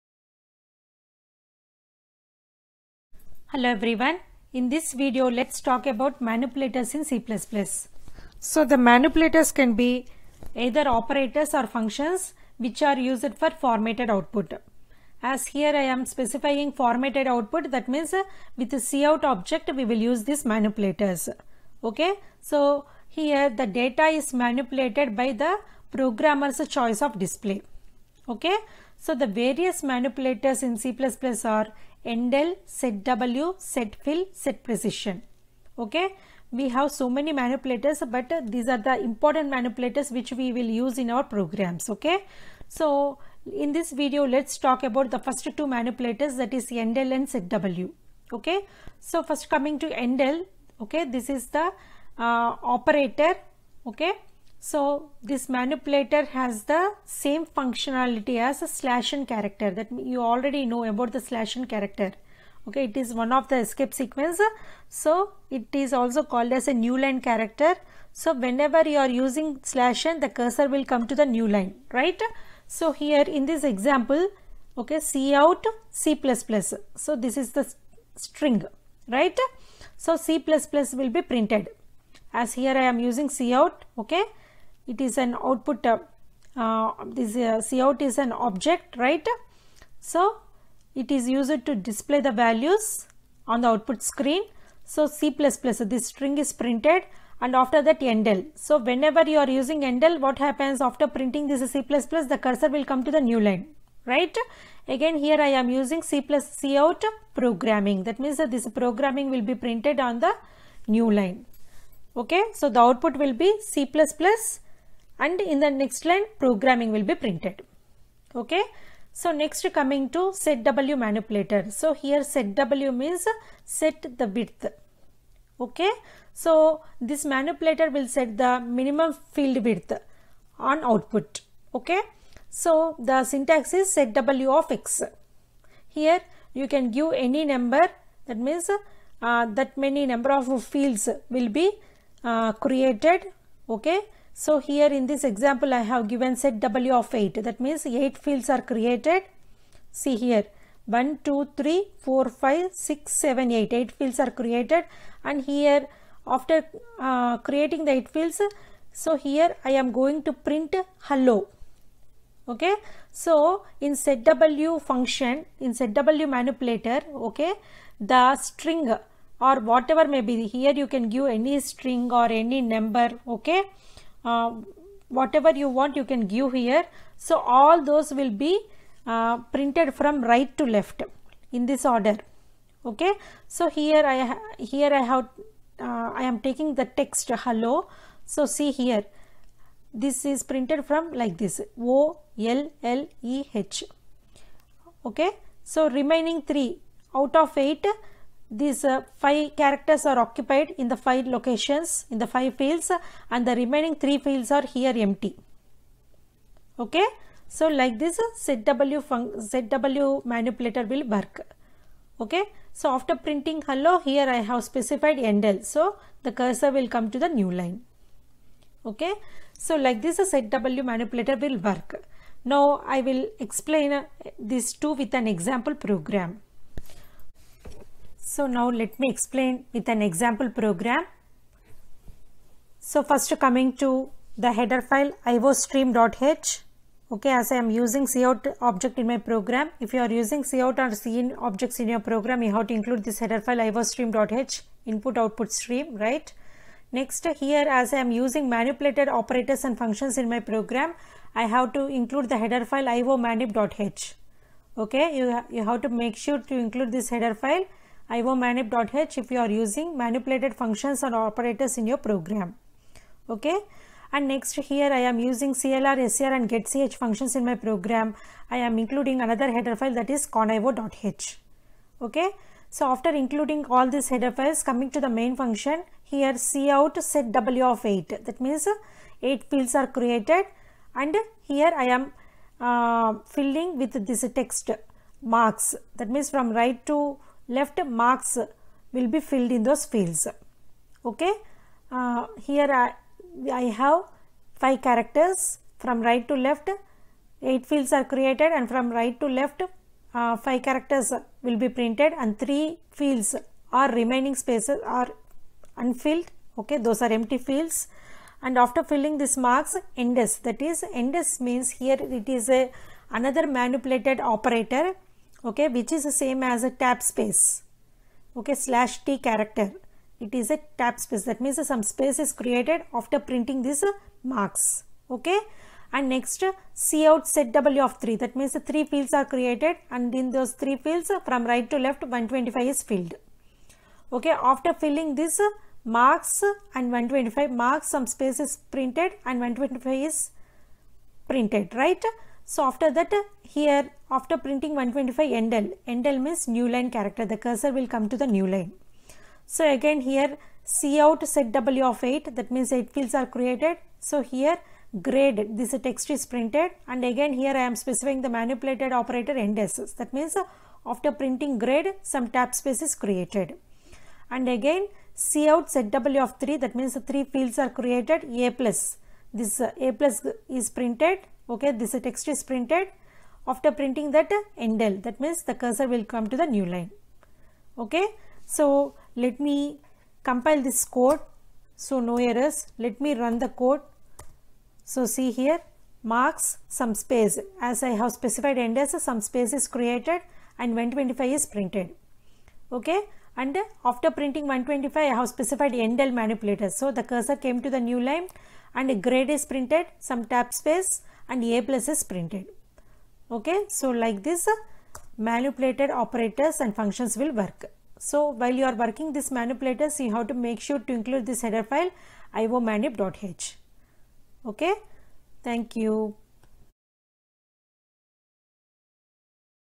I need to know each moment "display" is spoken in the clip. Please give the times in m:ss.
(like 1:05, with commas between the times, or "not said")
0:27, 1:31.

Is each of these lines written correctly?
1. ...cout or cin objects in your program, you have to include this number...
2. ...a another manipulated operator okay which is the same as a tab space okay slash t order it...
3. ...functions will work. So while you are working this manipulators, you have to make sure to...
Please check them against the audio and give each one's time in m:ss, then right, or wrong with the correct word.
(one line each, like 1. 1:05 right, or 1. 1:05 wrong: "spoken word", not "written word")
1. 4:00 wrong: "header", not "number"
2. 5:12 wrong: "character", not "order"
3. 6:46 right.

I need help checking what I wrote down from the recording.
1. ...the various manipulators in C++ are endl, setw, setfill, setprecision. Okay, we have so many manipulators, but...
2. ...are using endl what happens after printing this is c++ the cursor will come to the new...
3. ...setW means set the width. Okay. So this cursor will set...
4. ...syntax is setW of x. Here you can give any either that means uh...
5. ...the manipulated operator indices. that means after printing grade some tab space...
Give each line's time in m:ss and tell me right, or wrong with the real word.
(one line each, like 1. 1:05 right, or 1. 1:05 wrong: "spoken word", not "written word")
1. 0:29 right
2. 1:39 right
3. 2:02 wrong: "manipulator", not "cursor"
4. 2:13 wrong: "number", not "either"
5. 5:58 right.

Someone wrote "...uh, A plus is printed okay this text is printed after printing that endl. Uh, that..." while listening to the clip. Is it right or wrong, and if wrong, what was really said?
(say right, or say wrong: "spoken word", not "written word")
right.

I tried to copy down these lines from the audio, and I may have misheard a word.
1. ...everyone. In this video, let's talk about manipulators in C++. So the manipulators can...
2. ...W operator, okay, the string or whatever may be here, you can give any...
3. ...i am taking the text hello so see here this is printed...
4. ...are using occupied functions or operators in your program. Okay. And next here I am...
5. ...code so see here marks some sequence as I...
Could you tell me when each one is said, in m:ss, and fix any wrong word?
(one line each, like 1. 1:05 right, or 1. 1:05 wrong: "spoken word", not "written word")
1. 0:03 right
2. 2:45 wrong: "manipulator", not "operator"
3. 3:06 right
4. 4:19 wrong: "manipulated", not "occupied"
5. 6:23 wrong: "space", not "sequence".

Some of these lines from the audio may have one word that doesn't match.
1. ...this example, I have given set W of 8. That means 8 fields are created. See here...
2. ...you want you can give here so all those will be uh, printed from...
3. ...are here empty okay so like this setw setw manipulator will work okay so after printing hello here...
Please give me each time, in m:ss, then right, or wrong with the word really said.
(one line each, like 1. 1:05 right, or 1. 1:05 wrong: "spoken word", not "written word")
1. 2:25 right
2. 2:55 right
3. 3:24 right.